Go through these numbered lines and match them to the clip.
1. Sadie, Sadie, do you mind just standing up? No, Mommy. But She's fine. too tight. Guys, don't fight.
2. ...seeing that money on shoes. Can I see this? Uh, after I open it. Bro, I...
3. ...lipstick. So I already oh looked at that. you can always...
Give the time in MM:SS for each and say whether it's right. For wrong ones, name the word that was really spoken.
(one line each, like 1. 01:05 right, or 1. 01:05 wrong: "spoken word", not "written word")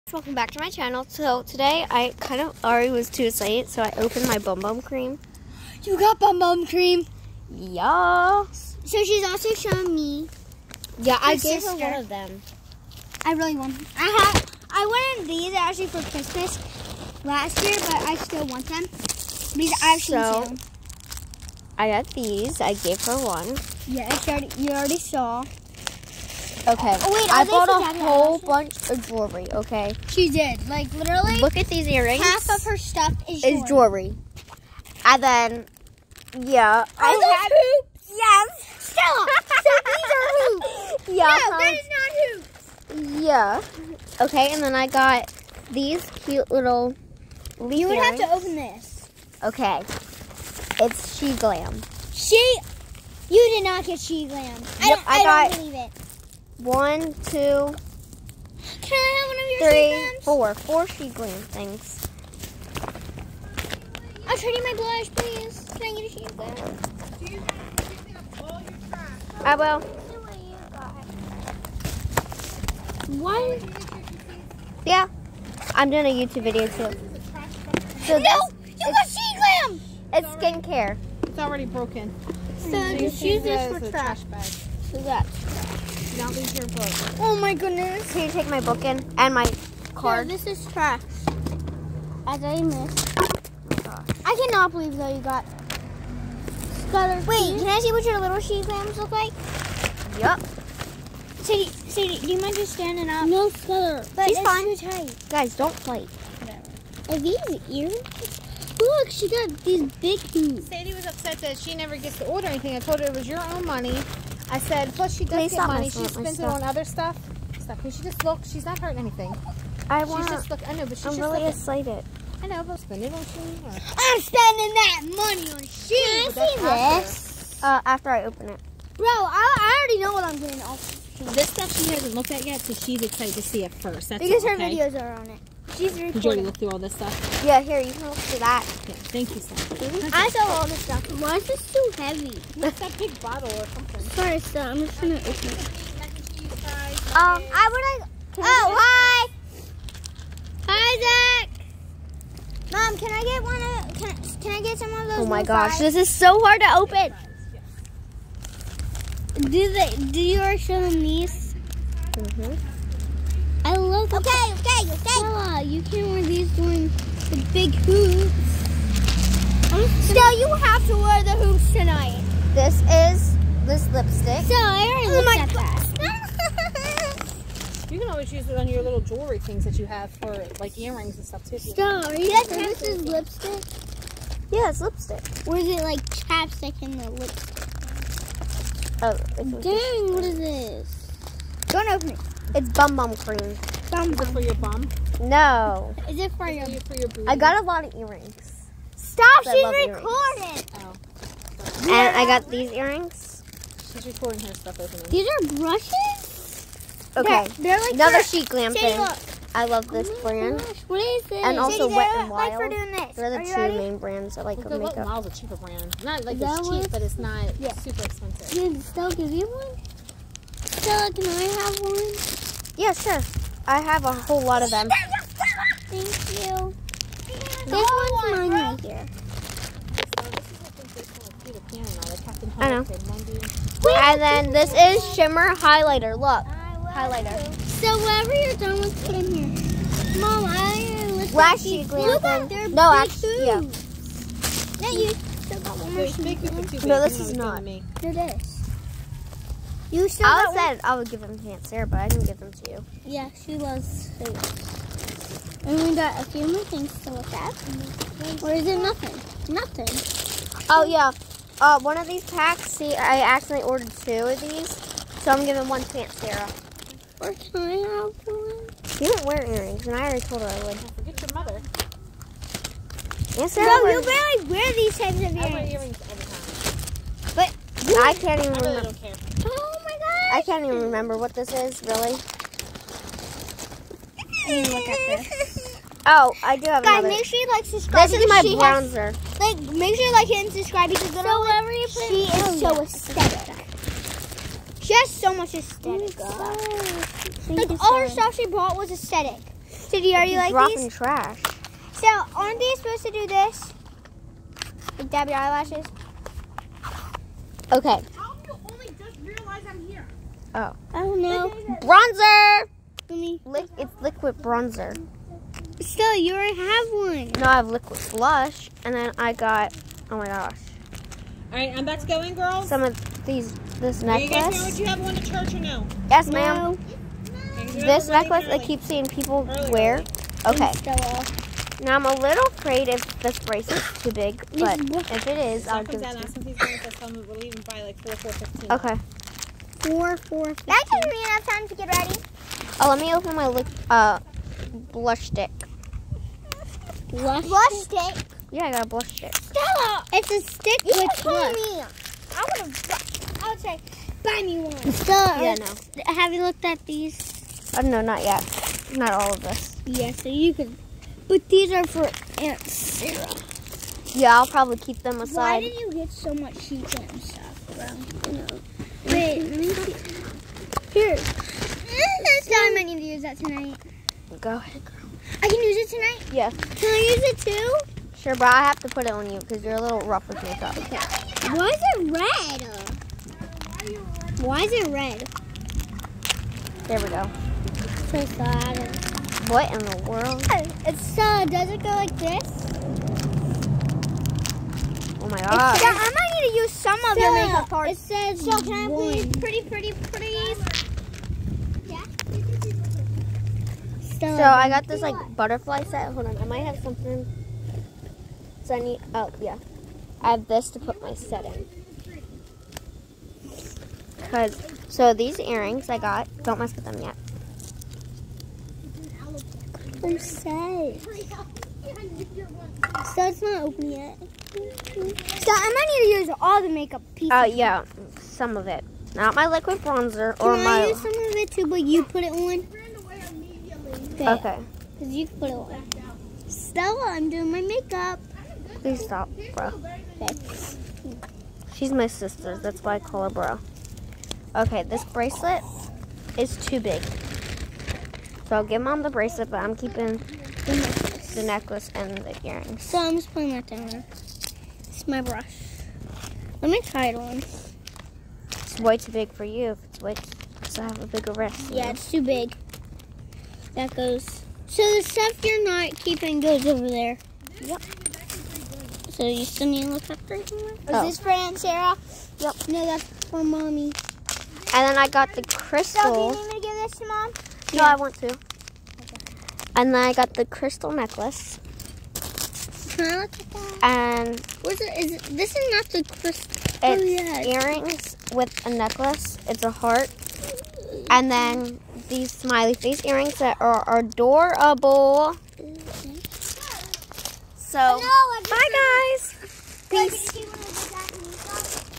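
1. 01:41 wrong: "Scutter", not "Mommy"
2. 02:04 wrong: "spending", not "seeing"
3. 02:53 right.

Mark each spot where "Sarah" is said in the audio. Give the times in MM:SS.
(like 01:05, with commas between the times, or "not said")
04:11, 04:26, 04:33, 06:02, 07:51.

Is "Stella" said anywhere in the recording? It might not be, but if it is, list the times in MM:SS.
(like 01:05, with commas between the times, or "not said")
00:38, 02:45, 02:50, 03:01, 03:40, 05:49, 05:54, 07:16.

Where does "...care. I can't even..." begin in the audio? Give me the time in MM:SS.
04:39.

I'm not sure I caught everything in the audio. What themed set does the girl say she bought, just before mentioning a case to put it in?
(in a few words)
Butterfly set.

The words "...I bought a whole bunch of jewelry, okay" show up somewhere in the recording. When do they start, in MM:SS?
00:27.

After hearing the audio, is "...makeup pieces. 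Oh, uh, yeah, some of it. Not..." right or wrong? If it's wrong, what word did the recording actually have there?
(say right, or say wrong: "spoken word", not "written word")
right.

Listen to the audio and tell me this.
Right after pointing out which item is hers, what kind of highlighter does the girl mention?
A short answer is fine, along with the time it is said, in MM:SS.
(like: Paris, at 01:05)
Shimmer highlighter, at 03:55.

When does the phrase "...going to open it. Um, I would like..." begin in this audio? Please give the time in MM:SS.
02:25.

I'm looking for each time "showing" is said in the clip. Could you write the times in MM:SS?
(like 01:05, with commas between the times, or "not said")
00:09, 02:40.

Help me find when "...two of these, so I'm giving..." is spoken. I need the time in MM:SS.
04:23.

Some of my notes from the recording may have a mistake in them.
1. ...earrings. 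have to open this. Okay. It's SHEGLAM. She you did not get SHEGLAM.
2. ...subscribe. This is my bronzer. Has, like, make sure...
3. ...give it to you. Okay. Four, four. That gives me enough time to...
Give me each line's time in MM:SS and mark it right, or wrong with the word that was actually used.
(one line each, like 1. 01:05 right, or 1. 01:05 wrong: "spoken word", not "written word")
1. 00:47 right
2. 04:47 right
3. 05:35 right.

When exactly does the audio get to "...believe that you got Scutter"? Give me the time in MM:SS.
01:34.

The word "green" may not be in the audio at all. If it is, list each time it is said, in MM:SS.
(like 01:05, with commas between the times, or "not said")
01:01, 01:06.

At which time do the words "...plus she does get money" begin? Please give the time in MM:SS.
01:54.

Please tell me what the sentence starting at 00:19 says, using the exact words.
These I've so, seen I got these.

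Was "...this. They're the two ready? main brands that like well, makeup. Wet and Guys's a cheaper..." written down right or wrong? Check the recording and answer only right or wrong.
wrong.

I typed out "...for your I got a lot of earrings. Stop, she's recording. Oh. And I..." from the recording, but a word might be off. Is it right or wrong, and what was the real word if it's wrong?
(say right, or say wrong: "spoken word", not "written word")
right.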